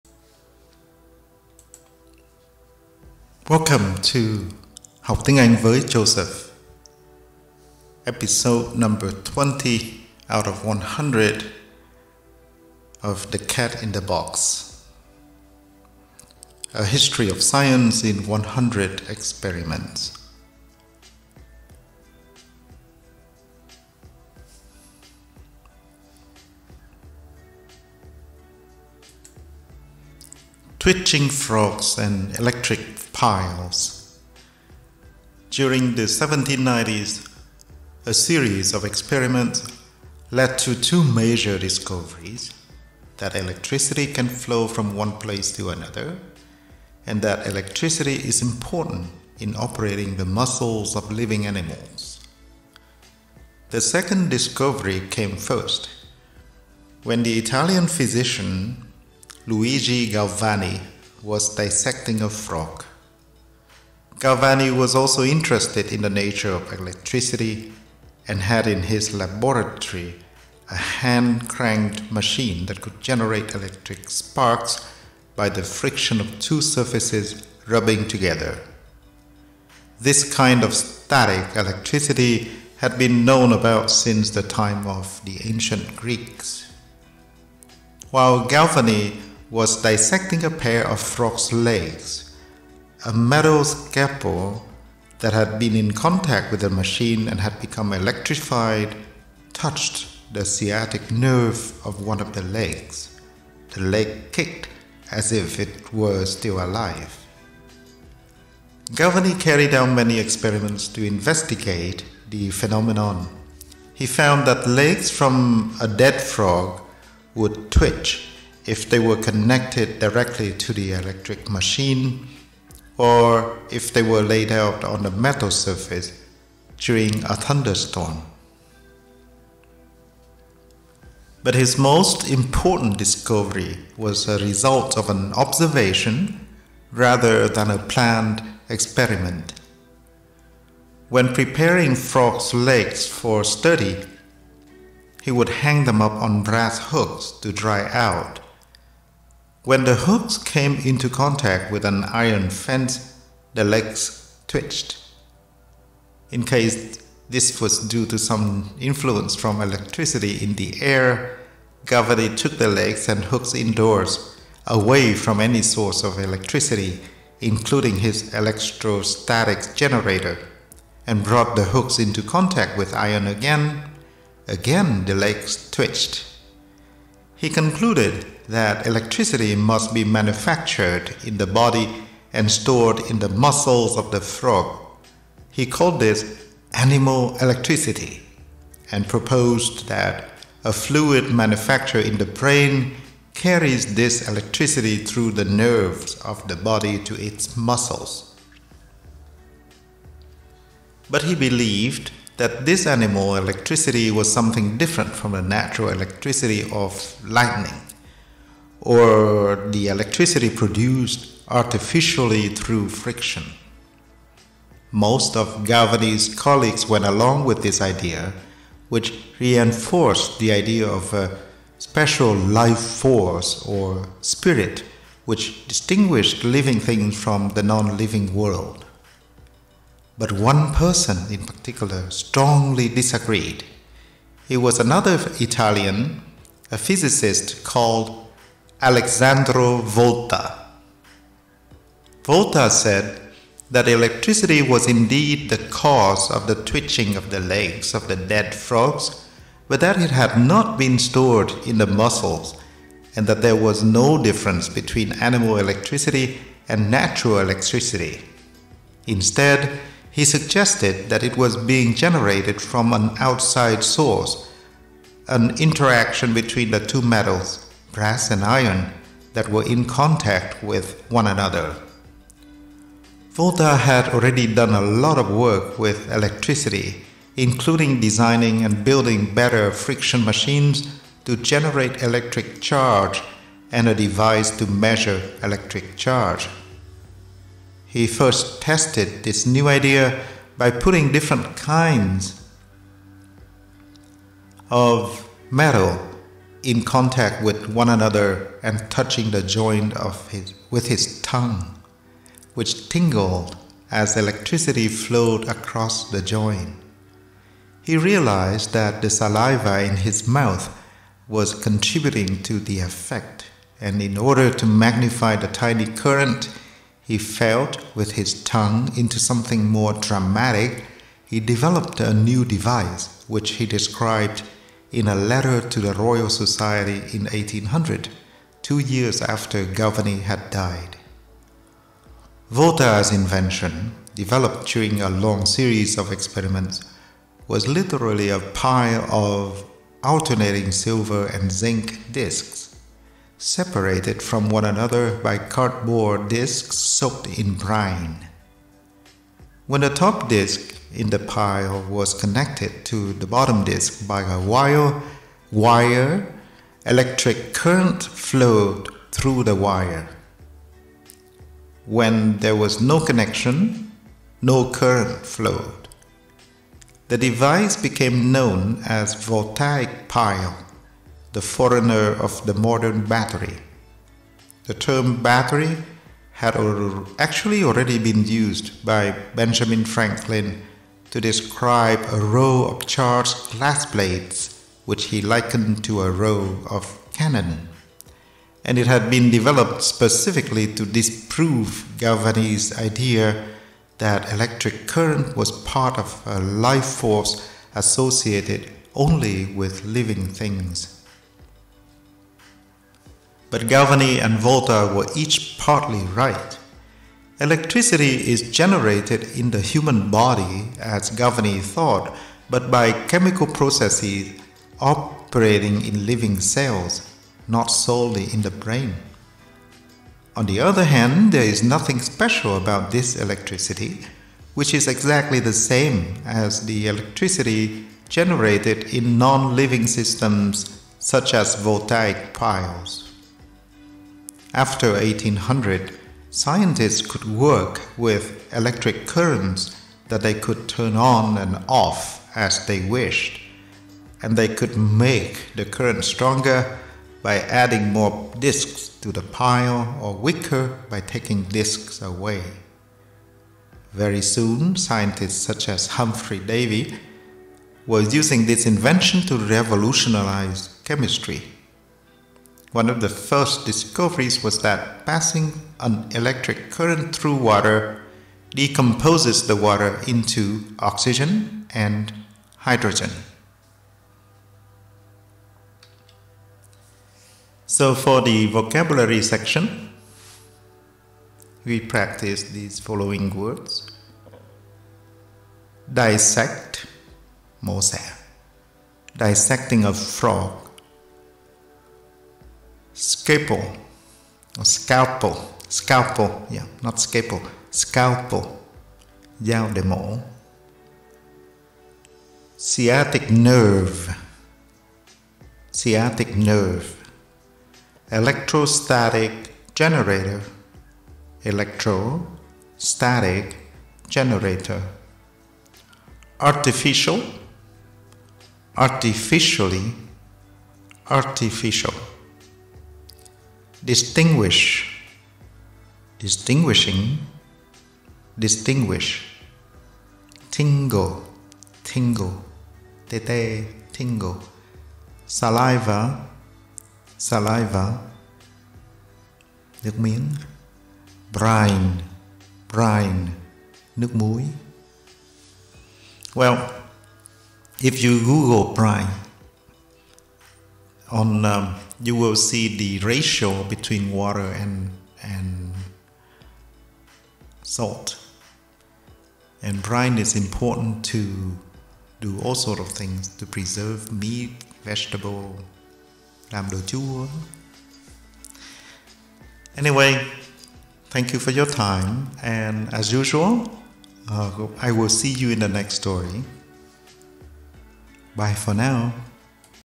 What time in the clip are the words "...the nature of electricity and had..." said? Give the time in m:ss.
1:06.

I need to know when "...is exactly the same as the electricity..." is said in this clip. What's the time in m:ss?
7:04.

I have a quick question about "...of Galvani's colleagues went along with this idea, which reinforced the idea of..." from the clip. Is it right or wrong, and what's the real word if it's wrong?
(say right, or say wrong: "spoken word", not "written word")
right.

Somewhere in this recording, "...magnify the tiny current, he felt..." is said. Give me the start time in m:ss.
5:14.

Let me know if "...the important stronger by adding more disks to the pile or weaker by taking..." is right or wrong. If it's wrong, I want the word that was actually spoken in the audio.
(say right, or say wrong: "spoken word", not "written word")
wrong: "current", not "important".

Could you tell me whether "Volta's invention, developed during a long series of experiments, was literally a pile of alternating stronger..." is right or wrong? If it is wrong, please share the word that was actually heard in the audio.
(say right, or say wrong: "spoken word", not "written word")
wrong: "silver", not "stronger".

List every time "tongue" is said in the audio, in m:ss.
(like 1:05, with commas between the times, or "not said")
5:01, 5:18.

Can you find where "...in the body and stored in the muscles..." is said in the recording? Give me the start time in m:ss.
3:01.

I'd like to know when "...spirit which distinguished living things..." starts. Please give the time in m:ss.
3:44.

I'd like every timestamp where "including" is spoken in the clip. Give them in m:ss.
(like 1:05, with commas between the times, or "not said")
2:47, 4:37.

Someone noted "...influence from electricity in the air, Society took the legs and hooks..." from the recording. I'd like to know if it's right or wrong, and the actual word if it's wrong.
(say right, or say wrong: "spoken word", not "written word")
wrong: "Galvani", not "Society".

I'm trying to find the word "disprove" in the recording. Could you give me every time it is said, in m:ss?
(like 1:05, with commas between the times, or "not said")
6:30.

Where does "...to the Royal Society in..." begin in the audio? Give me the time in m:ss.
5:25.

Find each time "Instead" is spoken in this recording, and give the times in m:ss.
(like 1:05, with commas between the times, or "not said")
4:19.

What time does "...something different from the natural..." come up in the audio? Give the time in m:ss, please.
3:24.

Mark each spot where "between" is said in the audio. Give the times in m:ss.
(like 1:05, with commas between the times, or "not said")
4:14, 4:26, 9:13.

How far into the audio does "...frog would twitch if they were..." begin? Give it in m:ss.
1:56.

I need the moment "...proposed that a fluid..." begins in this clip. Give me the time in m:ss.
3:09.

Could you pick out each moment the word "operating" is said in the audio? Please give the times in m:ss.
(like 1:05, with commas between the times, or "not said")
0:49, 6:54.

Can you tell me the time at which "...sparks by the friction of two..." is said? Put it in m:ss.
1:14.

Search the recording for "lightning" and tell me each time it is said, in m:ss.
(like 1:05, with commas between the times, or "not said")
3:27.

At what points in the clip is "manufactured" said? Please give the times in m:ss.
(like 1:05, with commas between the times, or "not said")
3:00, 3:11.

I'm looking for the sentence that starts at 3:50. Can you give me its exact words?
But one person in particular strongly disagreed.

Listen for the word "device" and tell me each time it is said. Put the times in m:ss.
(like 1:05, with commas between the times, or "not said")
4:43, 5:22, 6:07.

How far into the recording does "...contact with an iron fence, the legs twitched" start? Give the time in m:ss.
2:31.